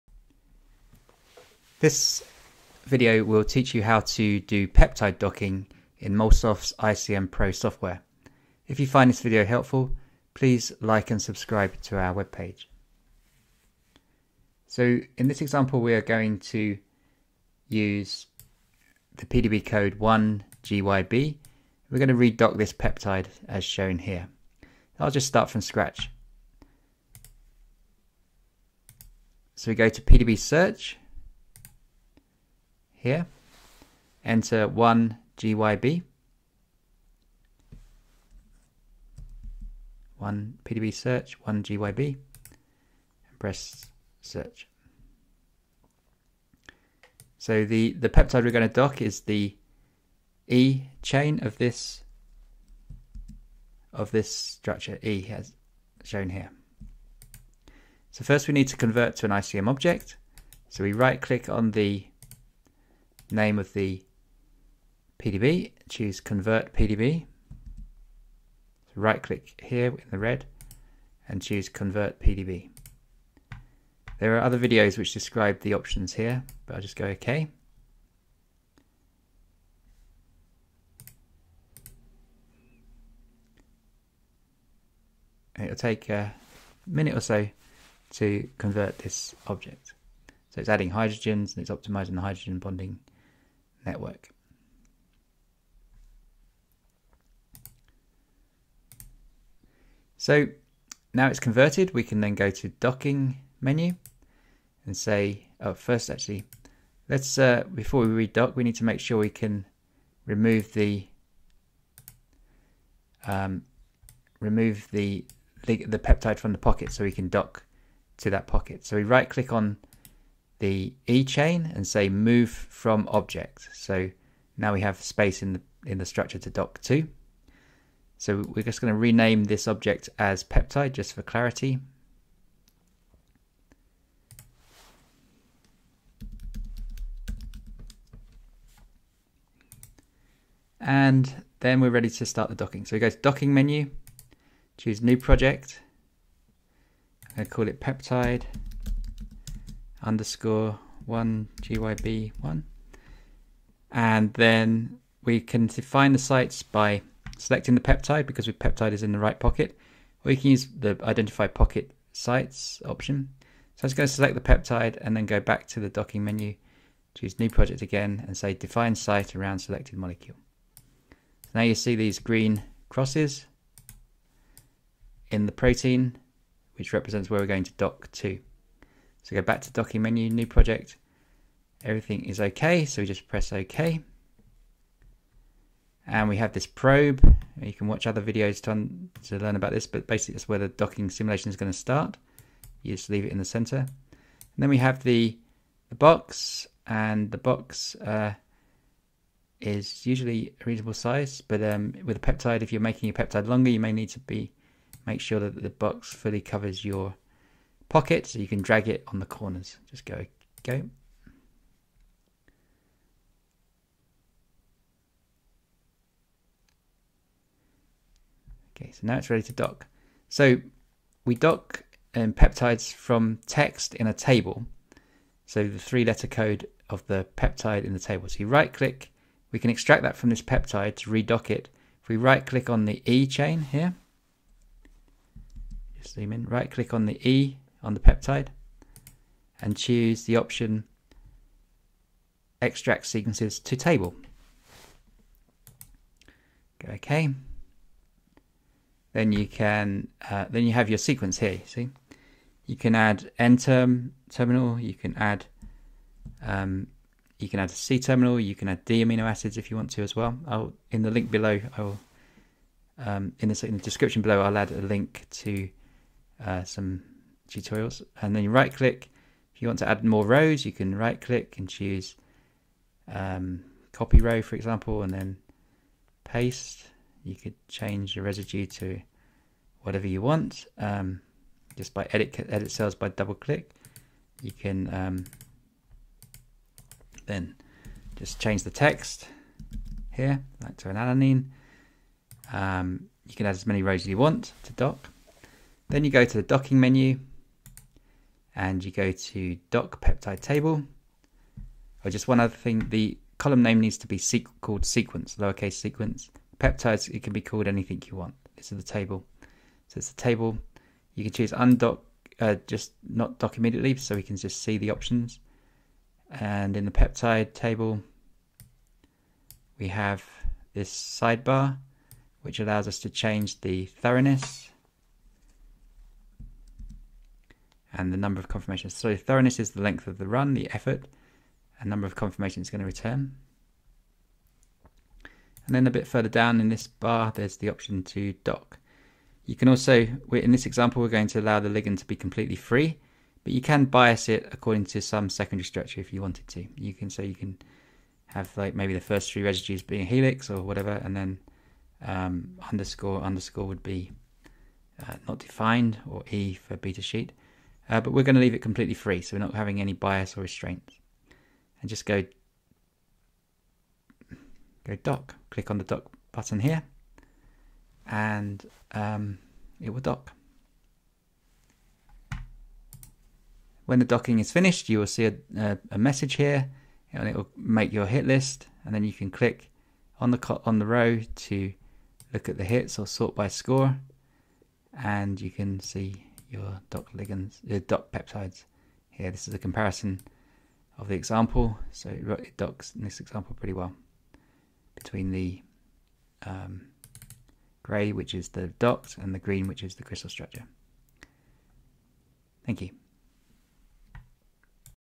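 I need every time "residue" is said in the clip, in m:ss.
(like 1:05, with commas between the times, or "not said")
4:38, 5:49.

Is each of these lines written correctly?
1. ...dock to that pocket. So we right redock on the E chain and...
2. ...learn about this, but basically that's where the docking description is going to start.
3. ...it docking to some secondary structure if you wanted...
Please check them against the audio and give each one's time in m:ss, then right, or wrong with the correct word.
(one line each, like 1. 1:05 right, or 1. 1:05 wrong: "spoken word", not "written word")
1. 1:57 wrong: "click", not "redock"
2. 3:09 wrong: "simulation", not "description"
3. 5:44 wrong: "according", not "docking".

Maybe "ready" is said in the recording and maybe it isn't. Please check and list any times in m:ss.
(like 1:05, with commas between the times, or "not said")
2:21, 3:39.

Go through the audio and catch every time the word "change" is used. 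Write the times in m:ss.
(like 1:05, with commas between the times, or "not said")
4:37, 4:48, 5:23.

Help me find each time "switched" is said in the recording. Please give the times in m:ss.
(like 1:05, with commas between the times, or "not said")
not said.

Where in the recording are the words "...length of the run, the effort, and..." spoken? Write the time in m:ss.
5:29.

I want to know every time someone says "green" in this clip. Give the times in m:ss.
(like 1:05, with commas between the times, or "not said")
2:52, 6:39.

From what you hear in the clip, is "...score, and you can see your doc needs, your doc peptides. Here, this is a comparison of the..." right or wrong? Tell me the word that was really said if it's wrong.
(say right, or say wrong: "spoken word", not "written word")
wrong: "ligands", not "needs".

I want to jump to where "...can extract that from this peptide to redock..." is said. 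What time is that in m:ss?
3:49.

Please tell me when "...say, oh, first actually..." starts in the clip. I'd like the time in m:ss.
1:44.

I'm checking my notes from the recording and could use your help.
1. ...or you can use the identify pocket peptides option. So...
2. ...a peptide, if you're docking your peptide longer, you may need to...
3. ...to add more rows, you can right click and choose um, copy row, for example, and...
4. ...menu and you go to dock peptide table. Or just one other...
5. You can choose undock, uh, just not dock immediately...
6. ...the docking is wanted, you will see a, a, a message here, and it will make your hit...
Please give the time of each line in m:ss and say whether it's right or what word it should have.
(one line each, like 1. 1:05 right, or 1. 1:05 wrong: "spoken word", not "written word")
1. 2:40 wrong: "sites", not "peptides"
2. 3:22 wrong: "making", not "docking"
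3. 4:29 right
4. 4:56 right
5. 5:11 right
6. 6:13 wrong: "finished", not "wanted".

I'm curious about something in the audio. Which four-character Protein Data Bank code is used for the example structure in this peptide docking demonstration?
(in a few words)
1GYB.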